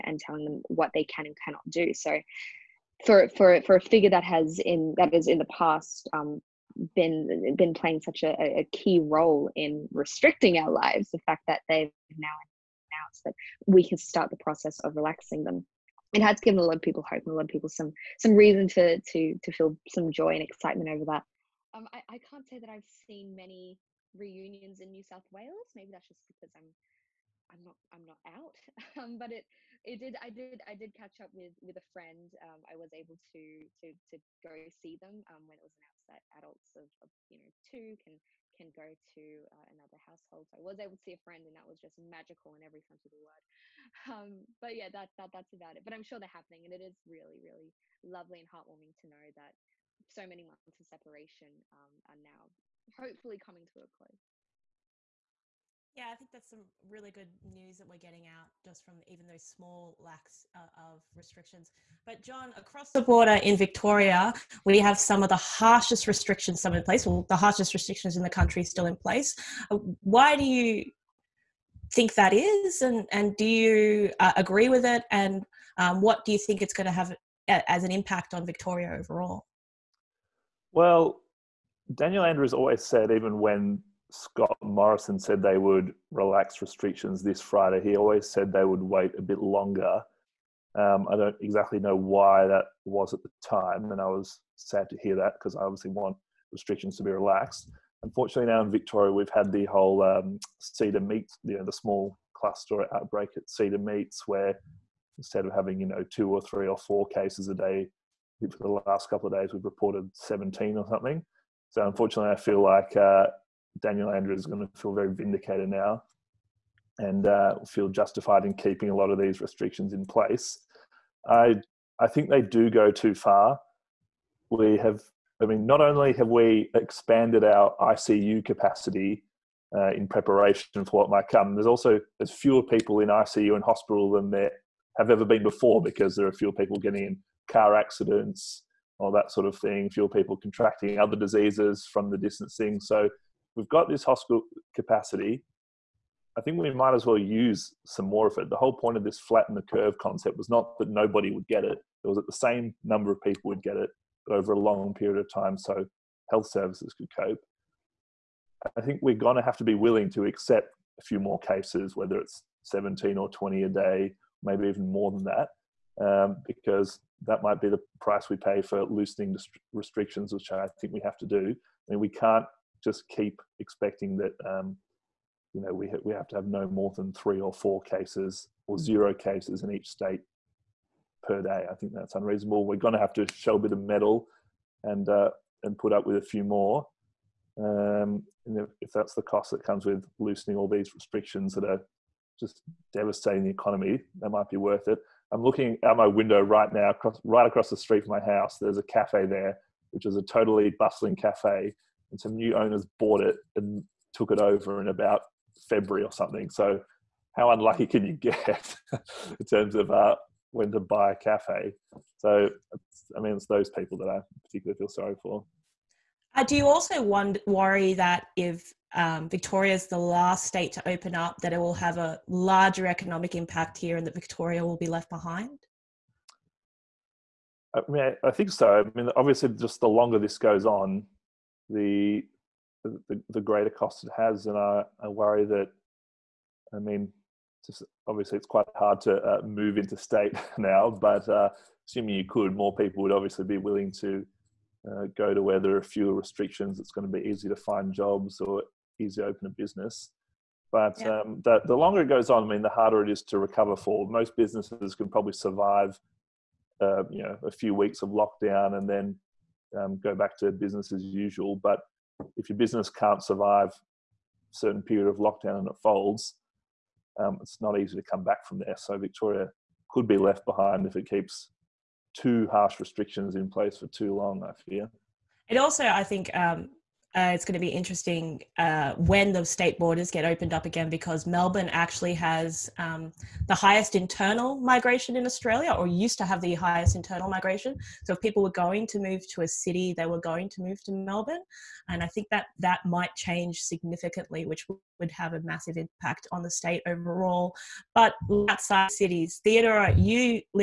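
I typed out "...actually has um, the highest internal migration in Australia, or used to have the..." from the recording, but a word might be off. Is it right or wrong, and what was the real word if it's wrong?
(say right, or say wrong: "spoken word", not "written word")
right.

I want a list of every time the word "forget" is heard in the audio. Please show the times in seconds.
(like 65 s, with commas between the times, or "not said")
not said.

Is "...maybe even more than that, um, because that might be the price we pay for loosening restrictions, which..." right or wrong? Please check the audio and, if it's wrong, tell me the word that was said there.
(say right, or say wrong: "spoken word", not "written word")
right.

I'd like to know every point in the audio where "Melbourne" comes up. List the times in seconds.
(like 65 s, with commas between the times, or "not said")
281 s, 290 s.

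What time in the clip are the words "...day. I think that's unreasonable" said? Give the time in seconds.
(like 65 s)
181 s.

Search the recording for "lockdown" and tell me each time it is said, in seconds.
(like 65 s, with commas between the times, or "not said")
258 s, 265 s.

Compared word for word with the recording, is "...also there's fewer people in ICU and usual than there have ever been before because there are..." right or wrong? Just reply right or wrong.
wrong.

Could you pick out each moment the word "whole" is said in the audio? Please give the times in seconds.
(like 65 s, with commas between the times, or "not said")
99 s, 148 s.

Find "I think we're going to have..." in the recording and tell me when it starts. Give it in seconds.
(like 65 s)
158 s.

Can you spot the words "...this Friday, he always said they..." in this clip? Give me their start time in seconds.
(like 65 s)
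87 s.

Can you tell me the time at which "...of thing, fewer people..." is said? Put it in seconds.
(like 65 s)
139 s.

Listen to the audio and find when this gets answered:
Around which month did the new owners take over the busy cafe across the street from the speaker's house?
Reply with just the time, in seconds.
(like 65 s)
205 s.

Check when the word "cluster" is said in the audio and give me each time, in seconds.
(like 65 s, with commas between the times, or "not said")
102 s.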